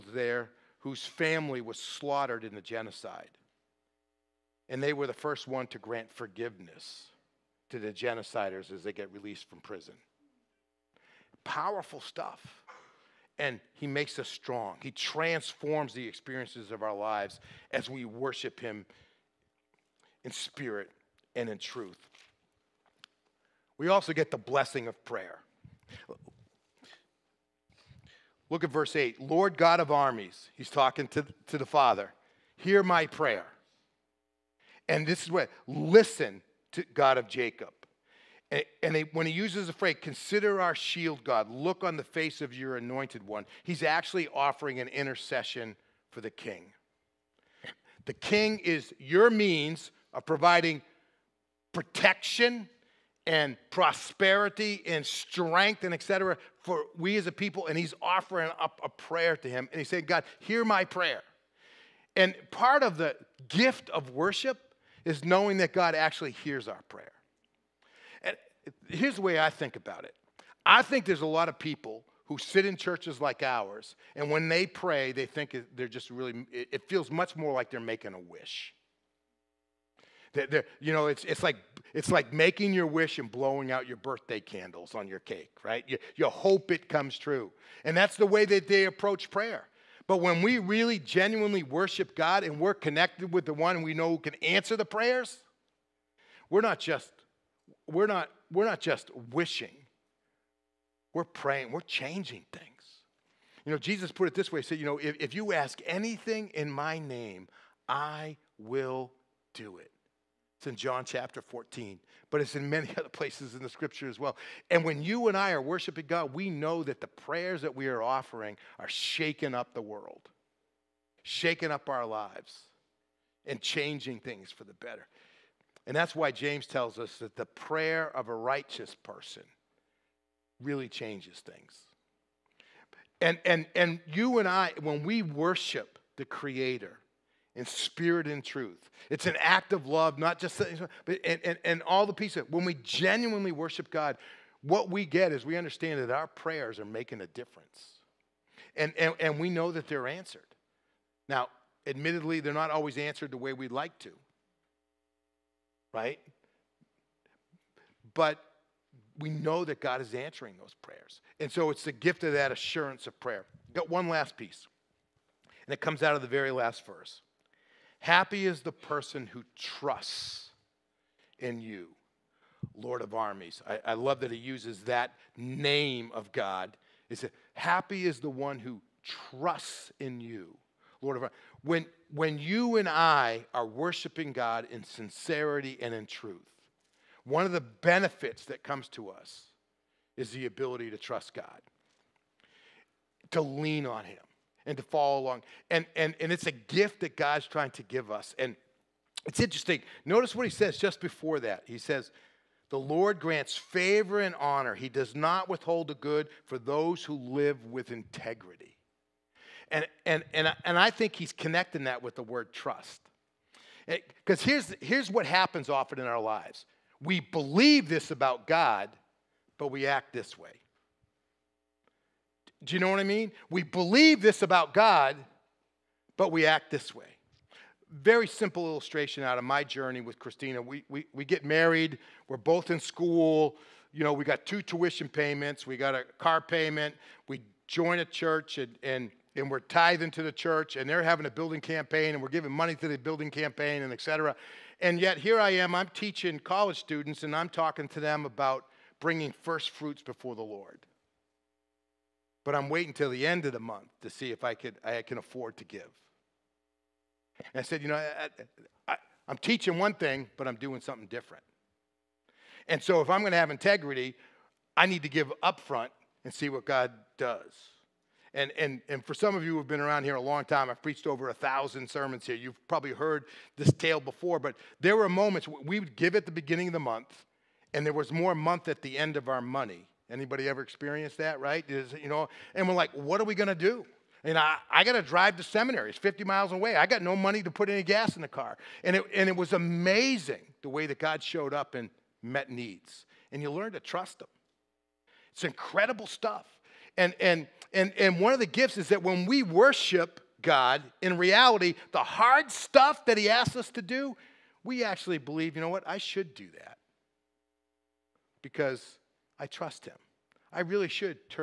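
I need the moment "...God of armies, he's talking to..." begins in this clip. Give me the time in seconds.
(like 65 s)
29 s.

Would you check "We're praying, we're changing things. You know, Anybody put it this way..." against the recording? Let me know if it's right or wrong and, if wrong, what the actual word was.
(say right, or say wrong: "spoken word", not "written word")
wrong: "Jesus", not "Anybody".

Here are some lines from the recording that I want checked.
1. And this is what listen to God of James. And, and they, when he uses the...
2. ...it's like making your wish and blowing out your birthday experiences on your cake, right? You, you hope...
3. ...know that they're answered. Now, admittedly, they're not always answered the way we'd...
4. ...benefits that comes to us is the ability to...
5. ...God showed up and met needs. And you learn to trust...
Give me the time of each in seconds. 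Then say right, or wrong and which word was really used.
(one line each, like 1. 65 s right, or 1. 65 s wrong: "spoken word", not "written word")
1. 34 s wrong: "Jacob", not "James"
2. 81 s wrong: "candles", not "experiences"
3. 149 s right
4. 187 s right
5. 290 s right.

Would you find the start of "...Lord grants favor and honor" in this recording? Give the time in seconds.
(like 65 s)
202 s.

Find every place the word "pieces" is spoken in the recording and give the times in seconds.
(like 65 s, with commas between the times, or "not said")
142 s, 164 s.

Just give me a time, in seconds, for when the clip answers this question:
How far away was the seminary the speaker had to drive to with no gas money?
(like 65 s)
285 s.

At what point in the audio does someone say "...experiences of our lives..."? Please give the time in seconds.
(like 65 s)
16 s.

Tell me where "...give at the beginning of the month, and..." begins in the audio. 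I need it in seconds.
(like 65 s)
275 s.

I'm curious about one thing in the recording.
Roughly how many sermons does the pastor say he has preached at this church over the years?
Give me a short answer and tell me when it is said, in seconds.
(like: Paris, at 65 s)
over 1000, at 271 s.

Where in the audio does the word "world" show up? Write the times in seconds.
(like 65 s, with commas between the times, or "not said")
119 s.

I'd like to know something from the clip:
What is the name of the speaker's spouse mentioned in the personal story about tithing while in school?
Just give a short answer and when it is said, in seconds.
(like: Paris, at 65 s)
Christina, at 230 s.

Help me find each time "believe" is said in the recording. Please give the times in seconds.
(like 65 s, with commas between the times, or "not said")
217 s, 223 s, 305 s.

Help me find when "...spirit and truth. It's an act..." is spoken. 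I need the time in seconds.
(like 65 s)
137 s.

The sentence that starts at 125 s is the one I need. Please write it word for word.
And that's why James tells us that the prayer of a righteous person really changes things.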